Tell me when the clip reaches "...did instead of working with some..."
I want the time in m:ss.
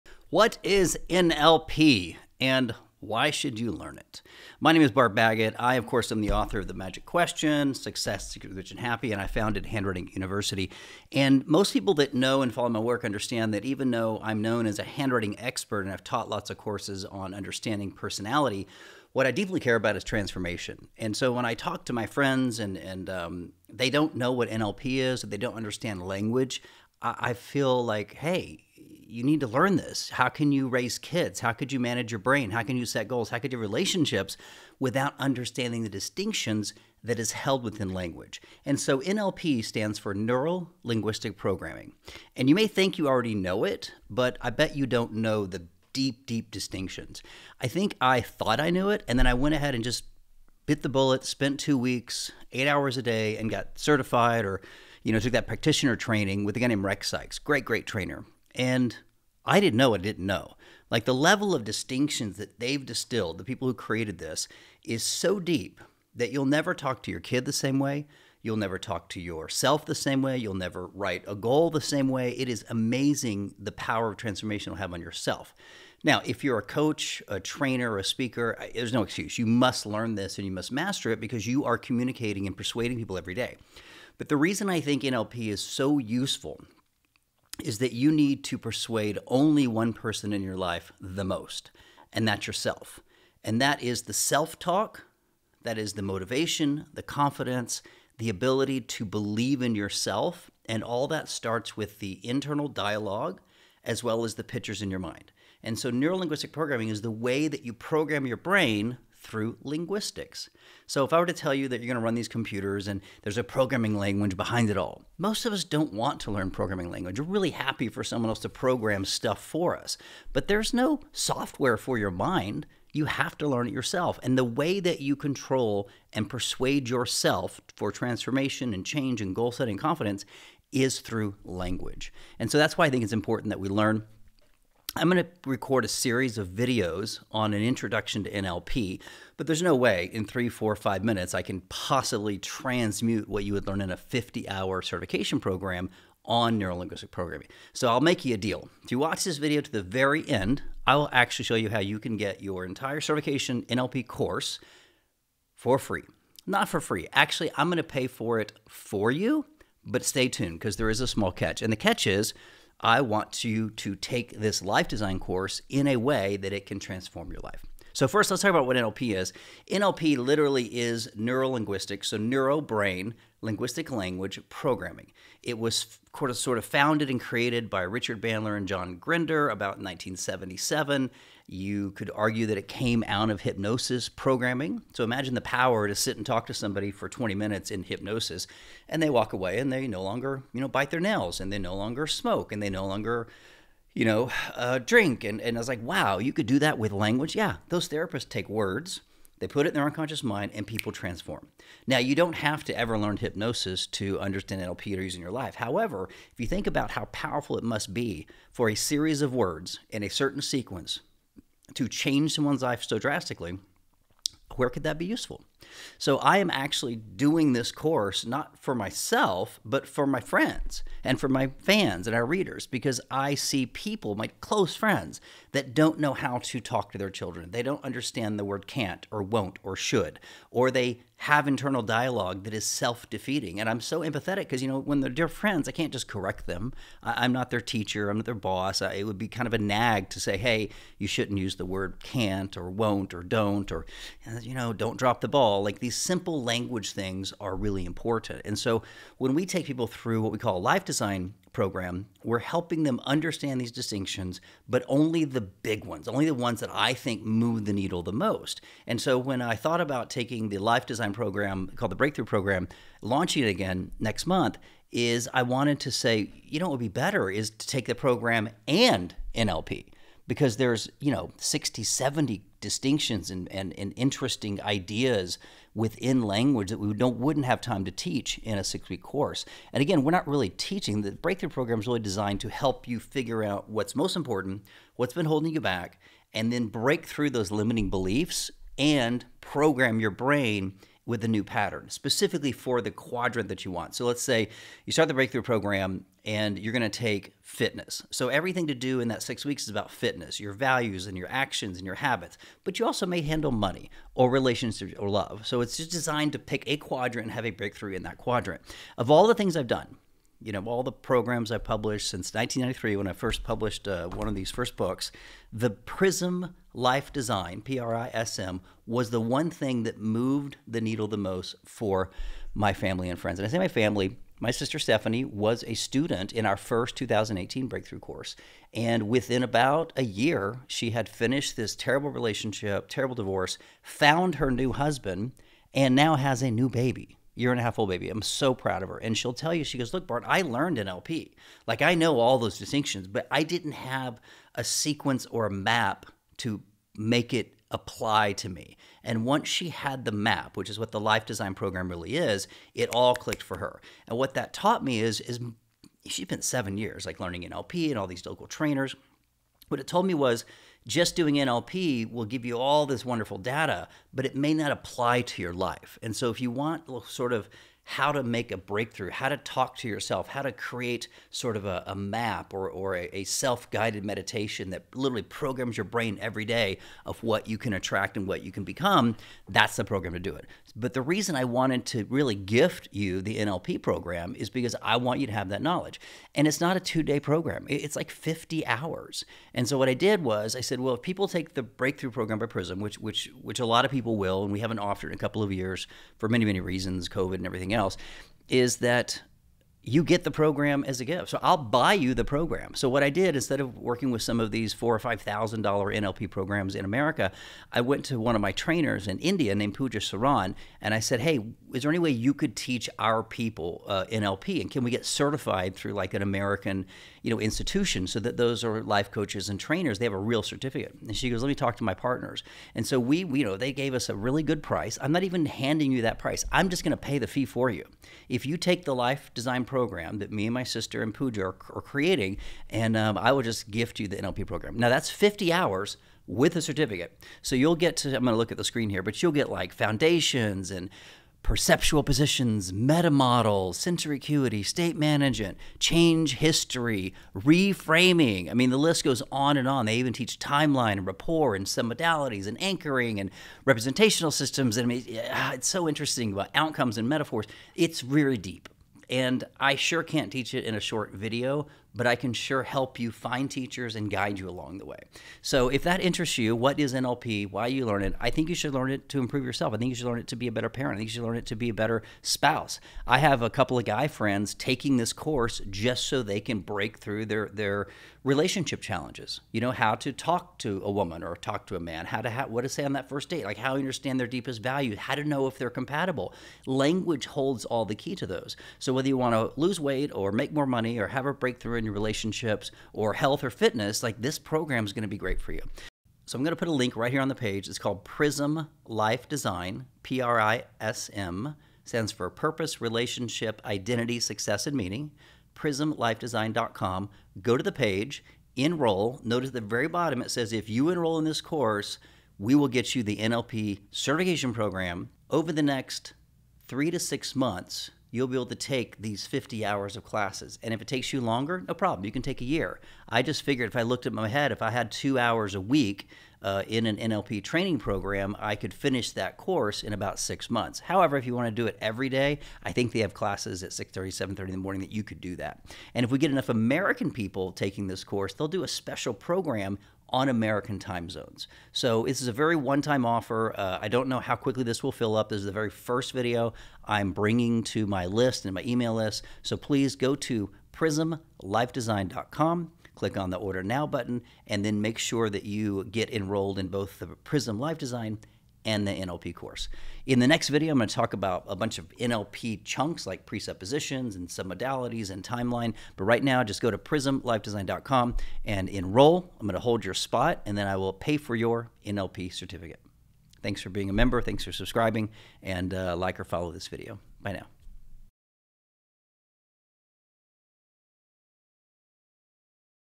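6:43.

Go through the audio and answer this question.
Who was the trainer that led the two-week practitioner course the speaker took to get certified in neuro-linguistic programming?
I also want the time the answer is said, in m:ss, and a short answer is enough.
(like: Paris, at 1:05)
Rex Sikes, at 0:56.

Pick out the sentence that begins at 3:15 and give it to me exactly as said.
And, and I was like, wow, you could do that with language.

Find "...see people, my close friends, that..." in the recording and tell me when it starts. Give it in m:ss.
3:43.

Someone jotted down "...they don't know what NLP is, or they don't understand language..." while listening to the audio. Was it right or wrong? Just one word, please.
right.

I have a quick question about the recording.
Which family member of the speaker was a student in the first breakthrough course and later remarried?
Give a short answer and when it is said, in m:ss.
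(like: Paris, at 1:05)
Stephanie, at 5:24.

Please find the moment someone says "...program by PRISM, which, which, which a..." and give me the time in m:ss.
6:32.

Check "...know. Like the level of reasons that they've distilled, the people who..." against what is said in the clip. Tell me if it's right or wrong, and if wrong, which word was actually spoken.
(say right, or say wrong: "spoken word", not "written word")
wrong: "distinctions", not "reasons".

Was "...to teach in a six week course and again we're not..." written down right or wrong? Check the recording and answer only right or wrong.
right.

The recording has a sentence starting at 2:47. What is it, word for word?
So first, let's talk about what NLP is.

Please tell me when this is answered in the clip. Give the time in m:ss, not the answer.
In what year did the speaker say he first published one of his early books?
5:12.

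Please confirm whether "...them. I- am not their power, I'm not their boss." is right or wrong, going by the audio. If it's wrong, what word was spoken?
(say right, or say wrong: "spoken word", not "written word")
wrong: "teacher", not "power".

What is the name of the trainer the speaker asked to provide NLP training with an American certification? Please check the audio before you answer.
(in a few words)
Pooja Saran.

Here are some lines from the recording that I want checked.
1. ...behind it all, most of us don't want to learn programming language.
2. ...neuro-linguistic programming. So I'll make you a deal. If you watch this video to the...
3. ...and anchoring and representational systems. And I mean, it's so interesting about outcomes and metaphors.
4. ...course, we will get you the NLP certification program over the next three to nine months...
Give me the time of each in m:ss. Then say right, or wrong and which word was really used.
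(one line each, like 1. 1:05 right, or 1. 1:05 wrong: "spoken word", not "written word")
1. 1:54 right
2. 2:26 right
3. 7:32 right
4. 8:31 wrong: "six", not "nine".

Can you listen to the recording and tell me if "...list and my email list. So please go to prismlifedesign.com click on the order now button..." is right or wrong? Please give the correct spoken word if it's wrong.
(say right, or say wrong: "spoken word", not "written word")
right.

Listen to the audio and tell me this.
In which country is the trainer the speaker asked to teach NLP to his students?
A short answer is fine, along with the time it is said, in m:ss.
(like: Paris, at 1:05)
India, at 6:49.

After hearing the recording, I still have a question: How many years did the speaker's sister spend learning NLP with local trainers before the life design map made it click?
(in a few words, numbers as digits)
7.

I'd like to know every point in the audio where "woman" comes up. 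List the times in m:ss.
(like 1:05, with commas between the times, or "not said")
8:00.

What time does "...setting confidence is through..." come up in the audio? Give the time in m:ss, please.
2:09.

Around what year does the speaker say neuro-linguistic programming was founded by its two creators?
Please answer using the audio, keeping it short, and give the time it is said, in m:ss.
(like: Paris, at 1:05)
1977, at 2:59.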